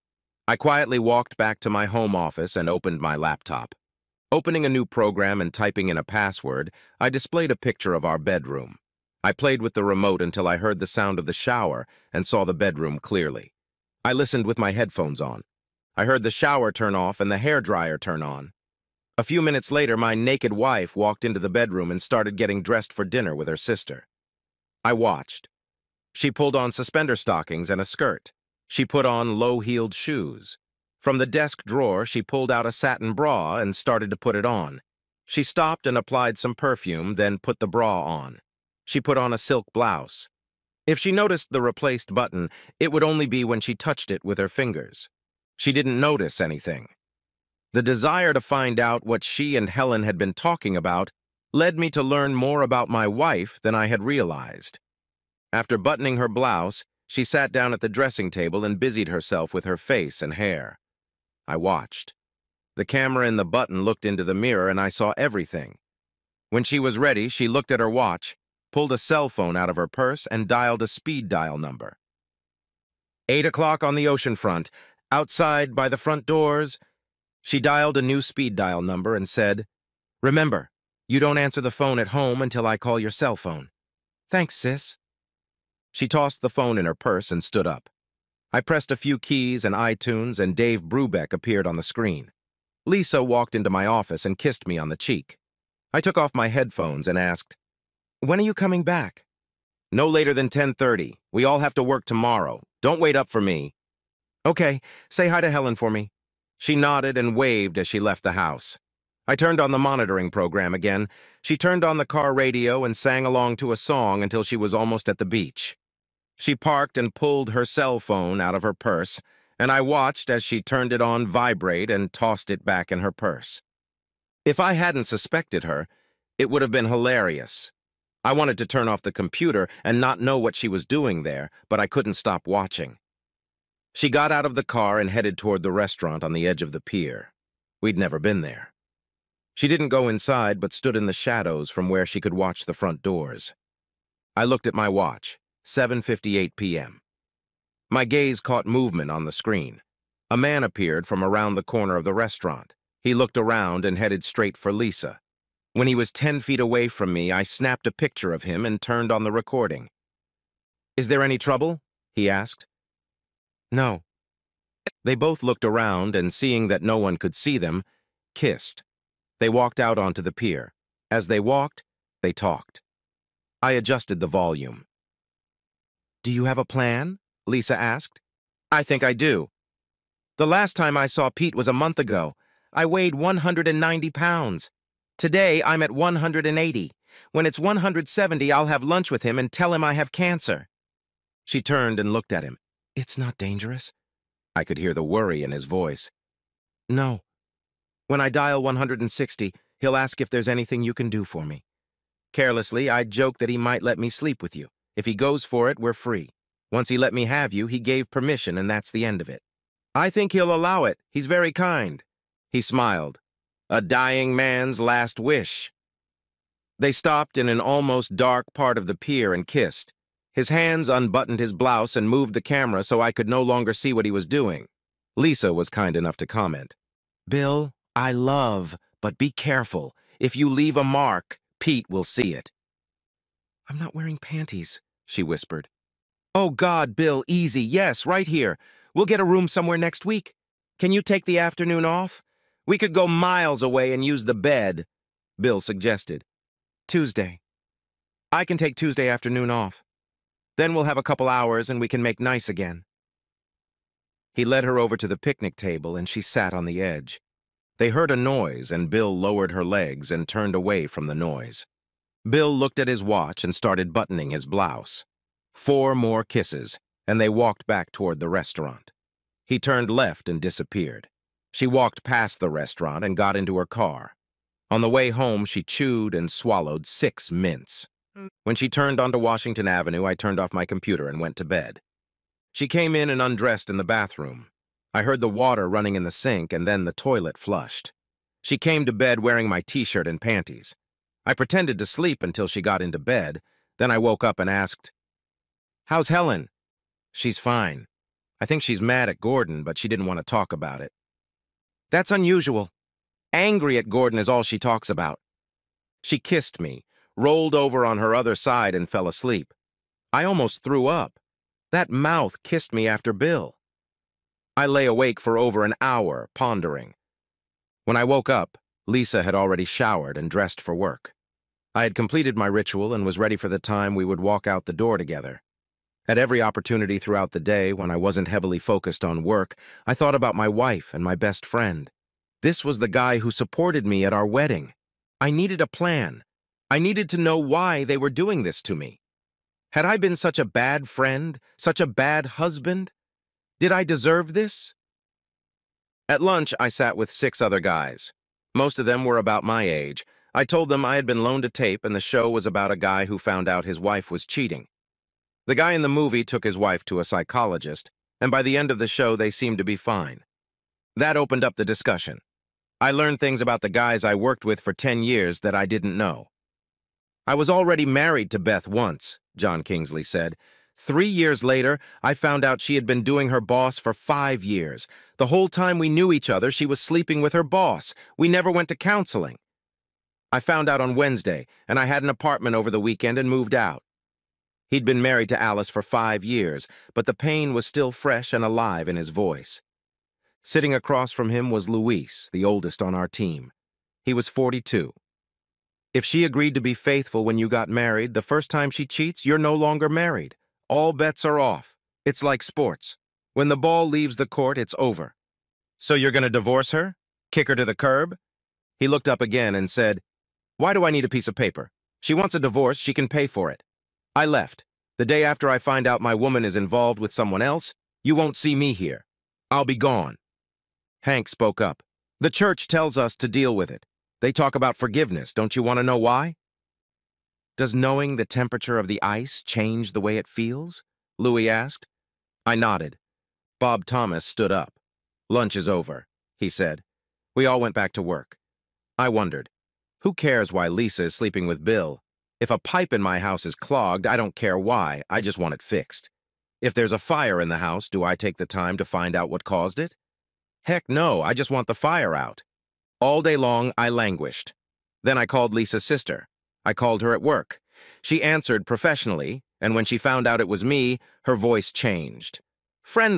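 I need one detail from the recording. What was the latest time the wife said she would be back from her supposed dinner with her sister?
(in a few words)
10:30.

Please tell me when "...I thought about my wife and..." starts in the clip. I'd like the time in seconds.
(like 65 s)
329 s.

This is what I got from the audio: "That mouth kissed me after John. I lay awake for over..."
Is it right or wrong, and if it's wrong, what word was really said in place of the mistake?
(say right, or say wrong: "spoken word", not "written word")
wrong: "Bill", not "John".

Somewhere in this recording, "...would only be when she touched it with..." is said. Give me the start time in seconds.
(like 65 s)
42 s.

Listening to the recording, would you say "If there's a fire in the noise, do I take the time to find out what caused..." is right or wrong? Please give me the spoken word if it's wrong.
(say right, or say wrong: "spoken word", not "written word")
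wrong: "house", not "noise".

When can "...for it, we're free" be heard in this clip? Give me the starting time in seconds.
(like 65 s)
205 s.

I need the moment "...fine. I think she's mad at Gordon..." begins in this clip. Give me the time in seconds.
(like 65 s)
297 s.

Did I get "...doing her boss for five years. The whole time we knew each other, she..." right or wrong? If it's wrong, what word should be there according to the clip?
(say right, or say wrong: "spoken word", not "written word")
right.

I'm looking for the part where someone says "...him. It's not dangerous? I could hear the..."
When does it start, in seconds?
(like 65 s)
192 s.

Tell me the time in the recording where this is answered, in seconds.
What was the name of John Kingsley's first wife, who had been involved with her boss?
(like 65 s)
368 s.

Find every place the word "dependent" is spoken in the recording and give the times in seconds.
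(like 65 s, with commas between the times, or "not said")
not said.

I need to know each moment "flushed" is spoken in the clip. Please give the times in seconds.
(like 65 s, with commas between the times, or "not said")
287 s.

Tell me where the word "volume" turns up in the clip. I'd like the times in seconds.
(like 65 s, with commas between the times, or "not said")
174 s.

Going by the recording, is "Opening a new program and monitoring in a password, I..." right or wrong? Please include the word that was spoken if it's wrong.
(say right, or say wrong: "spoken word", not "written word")
wrong: "typing", not "monitoring".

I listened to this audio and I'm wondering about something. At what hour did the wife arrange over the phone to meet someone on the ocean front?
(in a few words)
8 o'clock.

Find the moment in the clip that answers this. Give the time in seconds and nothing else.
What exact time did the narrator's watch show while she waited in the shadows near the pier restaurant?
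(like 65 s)
145 s.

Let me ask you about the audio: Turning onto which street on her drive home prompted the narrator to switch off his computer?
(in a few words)
Washington Avenue.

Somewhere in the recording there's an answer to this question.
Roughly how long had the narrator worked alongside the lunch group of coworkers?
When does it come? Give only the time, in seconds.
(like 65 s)
364 s.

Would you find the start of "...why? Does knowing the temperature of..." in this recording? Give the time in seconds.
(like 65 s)
425 s.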